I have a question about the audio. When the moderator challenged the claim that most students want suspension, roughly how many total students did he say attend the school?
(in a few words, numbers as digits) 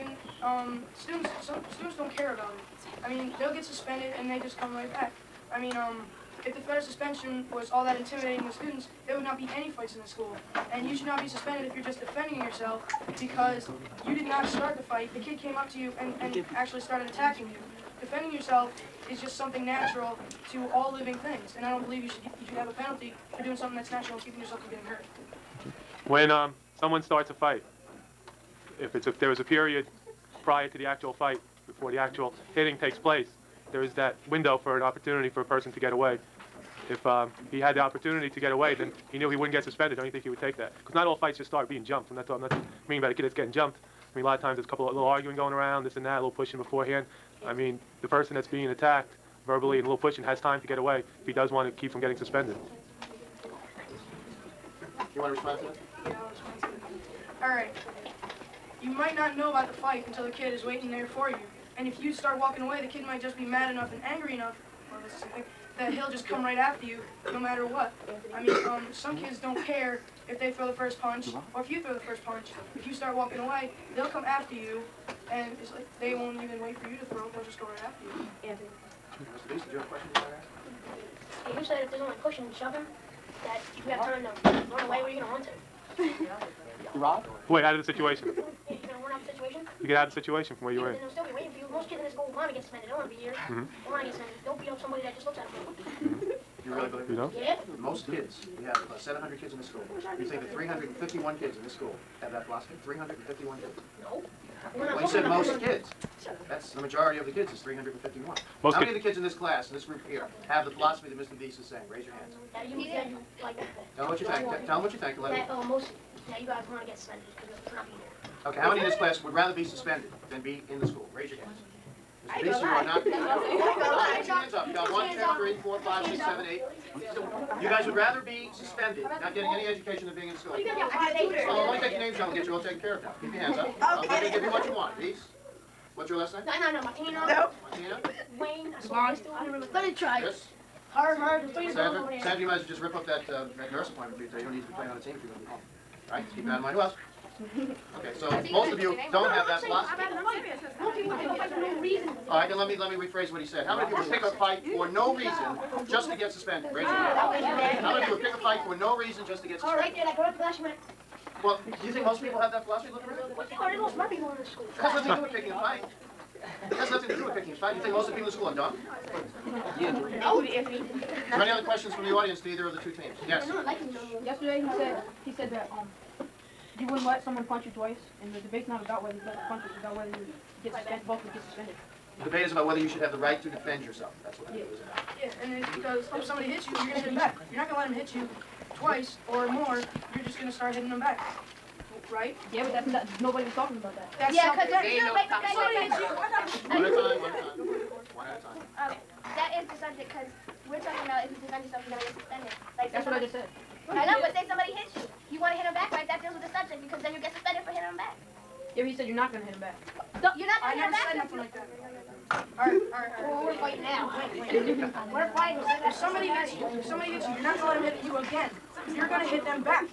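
700.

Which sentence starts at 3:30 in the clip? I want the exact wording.
So, you're not gonna I hit him back.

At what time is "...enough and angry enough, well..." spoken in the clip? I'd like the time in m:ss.
1:03.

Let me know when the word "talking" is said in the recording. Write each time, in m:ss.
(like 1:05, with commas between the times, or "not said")
0:42, 3:13, 3:20.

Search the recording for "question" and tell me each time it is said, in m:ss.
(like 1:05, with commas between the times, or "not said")
1:19, 2:51.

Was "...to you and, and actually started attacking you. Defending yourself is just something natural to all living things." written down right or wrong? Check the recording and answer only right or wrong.
right.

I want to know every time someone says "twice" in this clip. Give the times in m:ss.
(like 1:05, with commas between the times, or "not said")
2:57, 3:08.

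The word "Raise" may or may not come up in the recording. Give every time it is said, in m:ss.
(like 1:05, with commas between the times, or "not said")
1:51, 2:01, 2:36.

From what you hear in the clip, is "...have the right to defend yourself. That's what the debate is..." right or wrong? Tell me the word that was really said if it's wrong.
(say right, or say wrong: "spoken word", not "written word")
right.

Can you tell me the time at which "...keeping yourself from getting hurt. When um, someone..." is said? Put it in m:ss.
0:24.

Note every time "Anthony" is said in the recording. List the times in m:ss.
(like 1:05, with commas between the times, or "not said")
1:18, 2:50.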